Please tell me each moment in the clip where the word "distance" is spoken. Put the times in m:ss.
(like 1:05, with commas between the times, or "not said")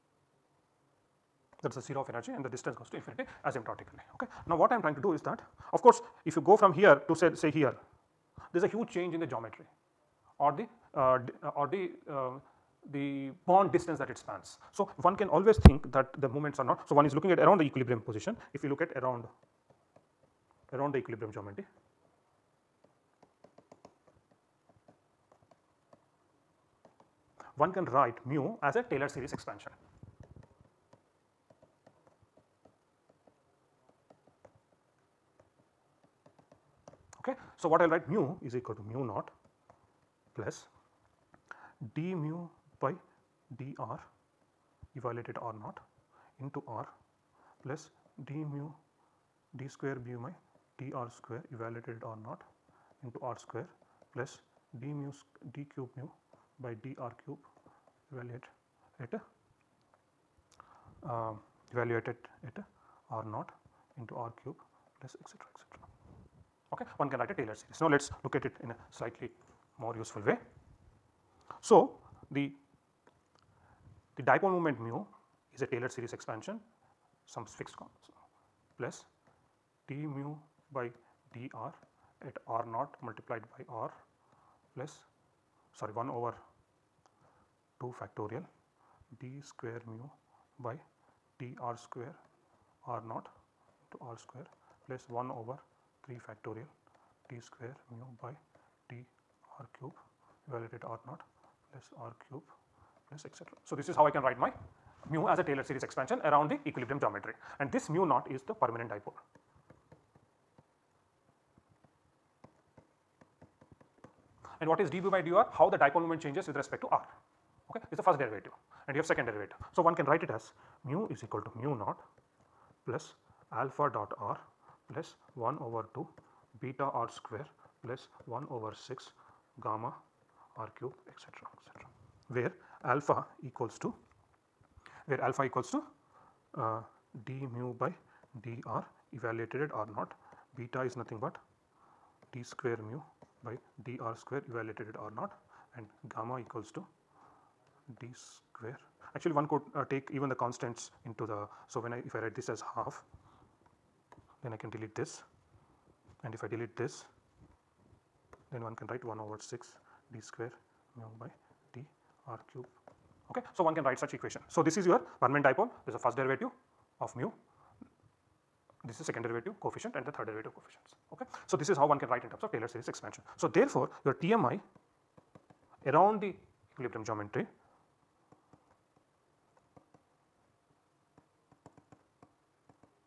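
0:02, 0:13.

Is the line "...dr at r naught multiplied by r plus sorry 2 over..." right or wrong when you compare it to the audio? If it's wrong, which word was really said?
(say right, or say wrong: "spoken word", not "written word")
wrong: "1", not "2".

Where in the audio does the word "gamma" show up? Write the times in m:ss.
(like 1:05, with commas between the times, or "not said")
2:09, 2:26.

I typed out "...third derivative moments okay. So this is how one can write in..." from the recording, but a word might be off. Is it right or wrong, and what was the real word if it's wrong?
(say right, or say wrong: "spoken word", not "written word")
wrong: "coefficients", not "moments".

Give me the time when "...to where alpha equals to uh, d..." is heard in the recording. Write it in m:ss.
2:13.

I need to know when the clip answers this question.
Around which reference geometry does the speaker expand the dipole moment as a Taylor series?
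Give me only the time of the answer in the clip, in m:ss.
0:17.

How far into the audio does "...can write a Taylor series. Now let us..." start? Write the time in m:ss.
1:07.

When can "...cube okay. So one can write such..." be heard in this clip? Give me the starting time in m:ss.
2:42.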